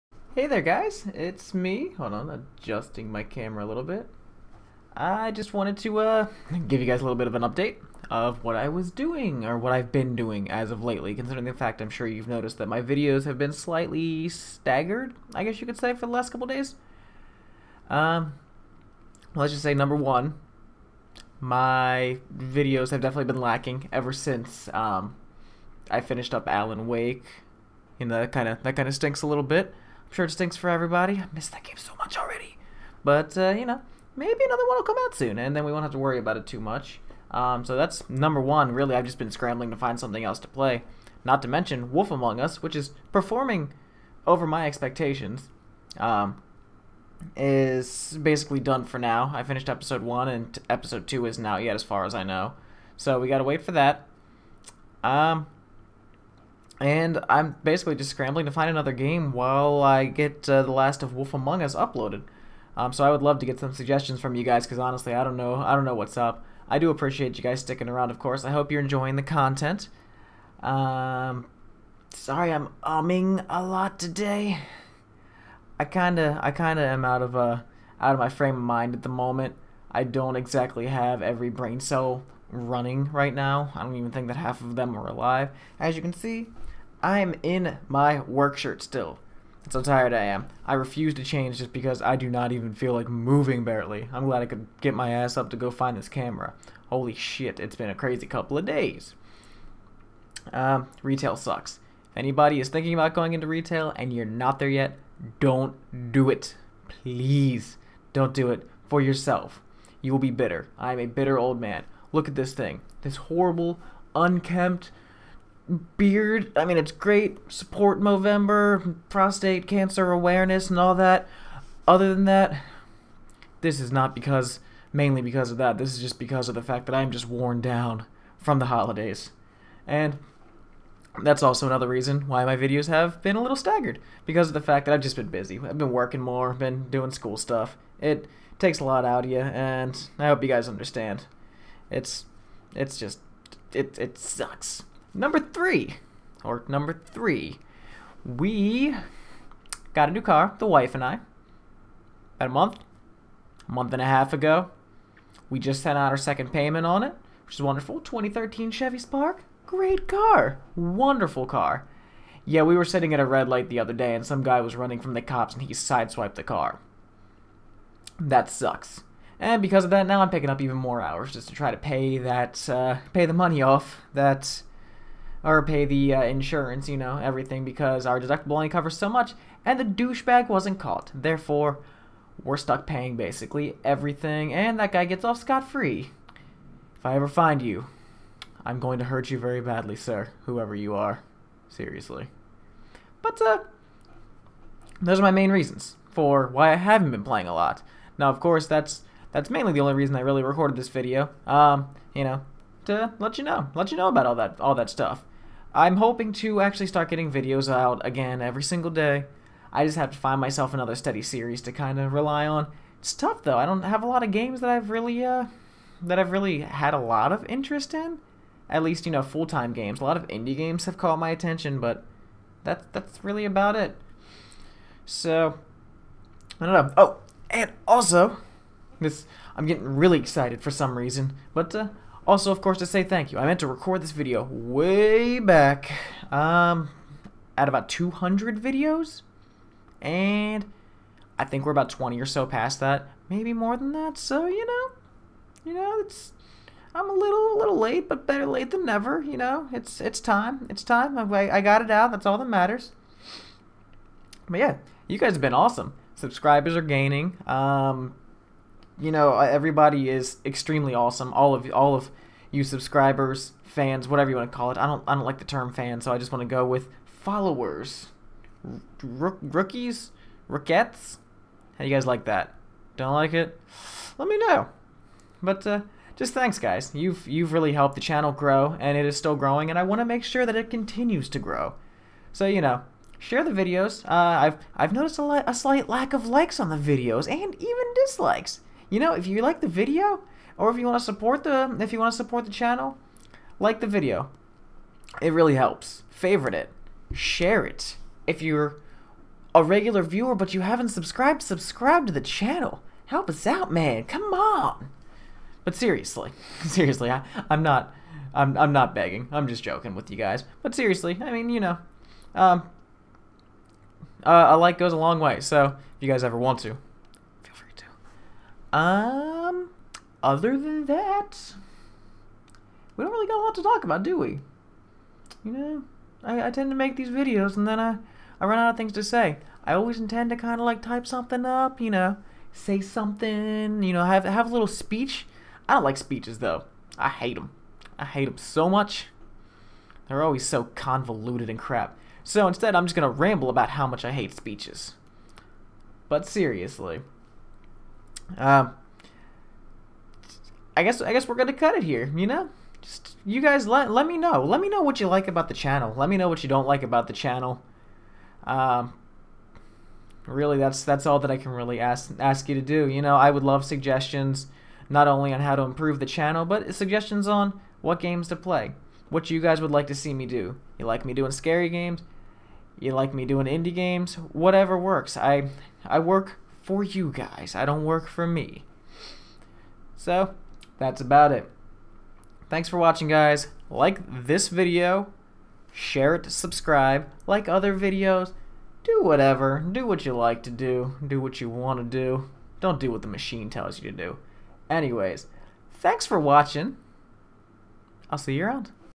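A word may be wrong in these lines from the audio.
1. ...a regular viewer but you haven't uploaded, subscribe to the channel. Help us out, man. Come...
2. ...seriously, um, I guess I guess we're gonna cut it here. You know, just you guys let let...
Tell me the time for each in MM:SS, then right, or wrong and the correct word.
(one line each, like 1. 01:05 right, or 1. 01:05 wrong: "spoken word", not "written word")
1. 04:59 wrong: "subscribed", not "uploaded"
2. 05:46 right.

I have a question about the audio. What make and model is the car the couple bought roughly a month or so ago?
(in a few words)
2013 Chevy Spark.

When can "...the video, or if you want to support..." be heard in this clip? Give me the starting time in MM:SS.
04:49.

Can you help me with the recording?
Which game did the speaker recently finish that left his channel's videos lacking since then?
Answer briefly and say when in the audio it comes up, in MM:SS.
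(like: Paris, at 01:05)
Alan Wake, at 00:26.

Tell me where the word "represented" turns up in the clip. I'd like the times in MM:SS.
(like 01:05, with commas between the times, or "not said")
not said.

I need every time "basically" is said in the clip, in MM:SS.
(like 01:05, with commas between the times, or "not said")
00:48, 00:57, 03:03.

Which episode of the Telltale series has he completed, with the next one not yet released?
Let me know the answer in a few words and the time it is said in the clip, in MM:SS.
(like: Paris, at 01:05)
episode one, at 00:49.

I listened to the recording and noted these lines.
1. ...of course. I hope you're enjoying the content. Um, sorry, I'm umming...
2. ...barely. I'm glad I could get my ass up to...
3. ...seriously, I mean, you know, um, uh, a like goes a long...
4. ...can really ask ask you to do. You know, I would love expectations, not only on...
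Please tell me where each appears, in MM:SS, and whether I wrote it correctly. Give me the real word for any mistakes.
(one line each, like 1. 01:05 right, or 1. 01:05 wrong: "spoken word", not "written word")
1. 01:08 right
2. 01:33 right
3. 05:10 right
4. 06:01 wrong: "suggestions", not "expectations".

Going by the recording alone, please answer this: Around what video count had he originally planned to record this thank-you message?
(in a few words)
200.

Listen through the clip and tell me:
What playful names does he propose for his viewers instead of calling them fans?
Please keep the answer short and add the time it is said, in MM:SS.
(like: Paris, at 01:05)
rookies, rookettes, at 04:29.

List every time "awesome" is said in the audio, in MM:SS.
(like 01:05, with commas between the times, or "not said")
04:15, 04:20.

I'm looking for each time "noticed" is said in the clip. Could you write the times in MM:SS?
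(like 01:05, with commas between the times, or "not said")
00:12, 04:44.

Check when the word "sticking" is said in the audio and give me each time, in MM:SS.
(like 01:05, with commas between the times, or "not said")
01:07.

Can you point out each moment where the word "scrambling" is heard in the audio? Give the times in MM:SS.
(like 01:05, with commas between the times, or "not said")
00:39, 00:58.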